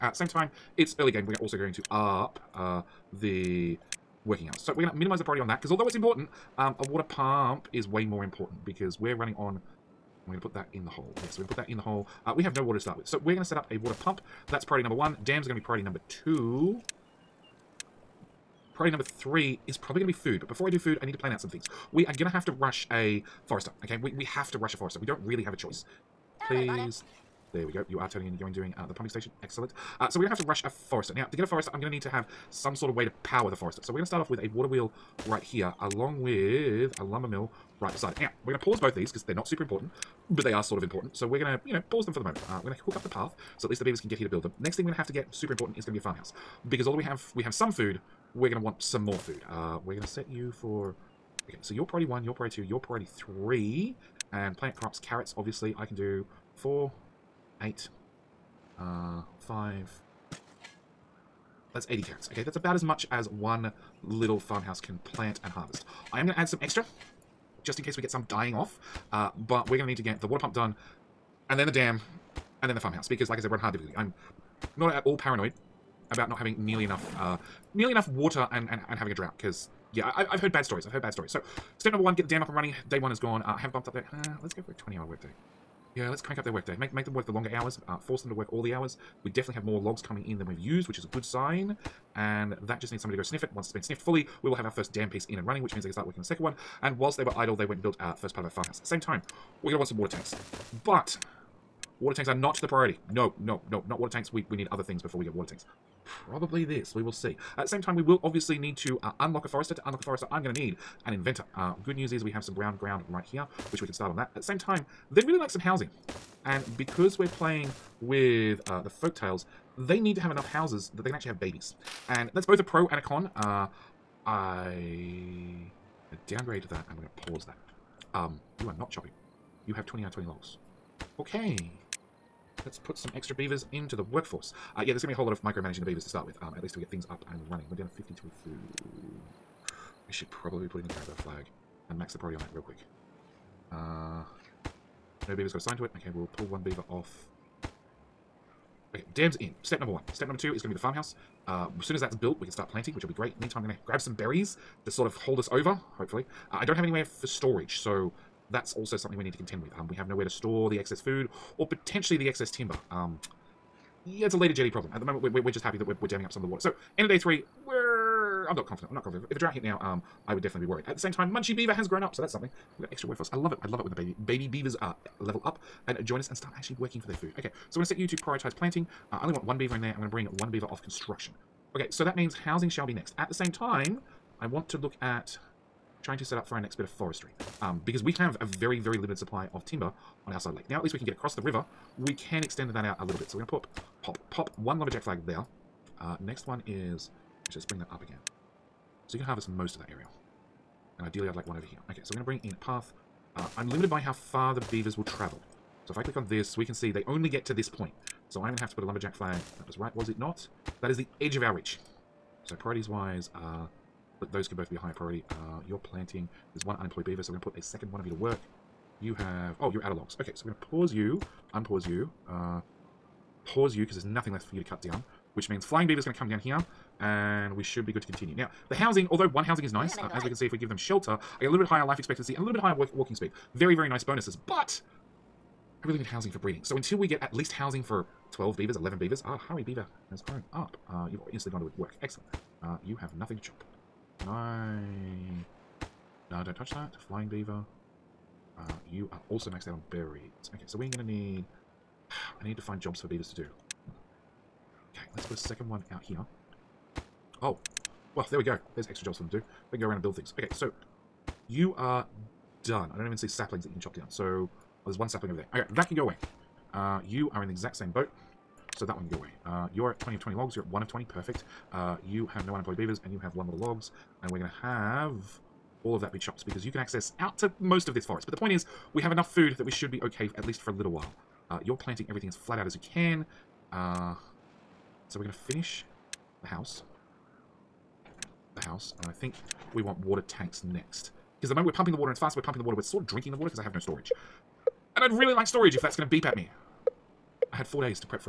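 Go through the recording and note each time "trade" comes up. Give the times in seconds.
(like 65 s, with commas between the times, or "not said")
not said.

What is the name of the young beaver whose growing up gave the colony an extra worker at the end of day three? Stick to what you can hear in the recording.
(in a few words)
Munchie Beaver.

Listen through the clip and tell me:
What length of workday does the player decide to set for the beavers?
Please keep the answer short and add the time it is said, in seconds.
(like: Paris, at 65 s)
20 hours, at 84 s.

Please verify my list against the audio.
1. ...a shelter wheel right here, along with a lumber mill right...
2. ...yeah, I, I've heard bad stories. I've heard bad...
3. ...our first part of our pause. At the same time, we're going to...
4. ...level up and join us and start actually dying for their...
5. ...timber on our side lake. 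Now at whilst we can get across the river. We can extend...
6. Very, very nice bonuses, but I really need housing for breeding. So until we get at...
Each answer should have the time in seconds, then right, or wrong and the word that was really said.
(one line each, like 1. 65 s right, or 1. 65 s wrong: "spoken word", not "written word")
1. 34 s wrong: "water", not "shelter"
2. 79 s right
3. 97 s wrong: "farmhouse", not "pause"
4. 175 s wrong: "working", not "dying"
5. 189 s wrong: "least", not "whilst"
6. 233 s right.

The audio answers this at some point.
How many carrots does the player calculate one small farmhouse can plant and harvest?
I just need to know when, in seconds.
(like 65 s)
61 s.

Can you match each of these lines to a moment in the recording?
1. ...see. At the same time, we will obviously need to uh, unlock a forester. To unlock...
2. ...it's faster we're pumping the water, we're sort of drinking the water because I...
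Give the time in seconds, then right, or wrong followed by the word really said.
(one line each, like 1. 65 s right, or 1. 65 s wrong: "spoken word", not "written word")
1. 107 s right
2. 292 s right.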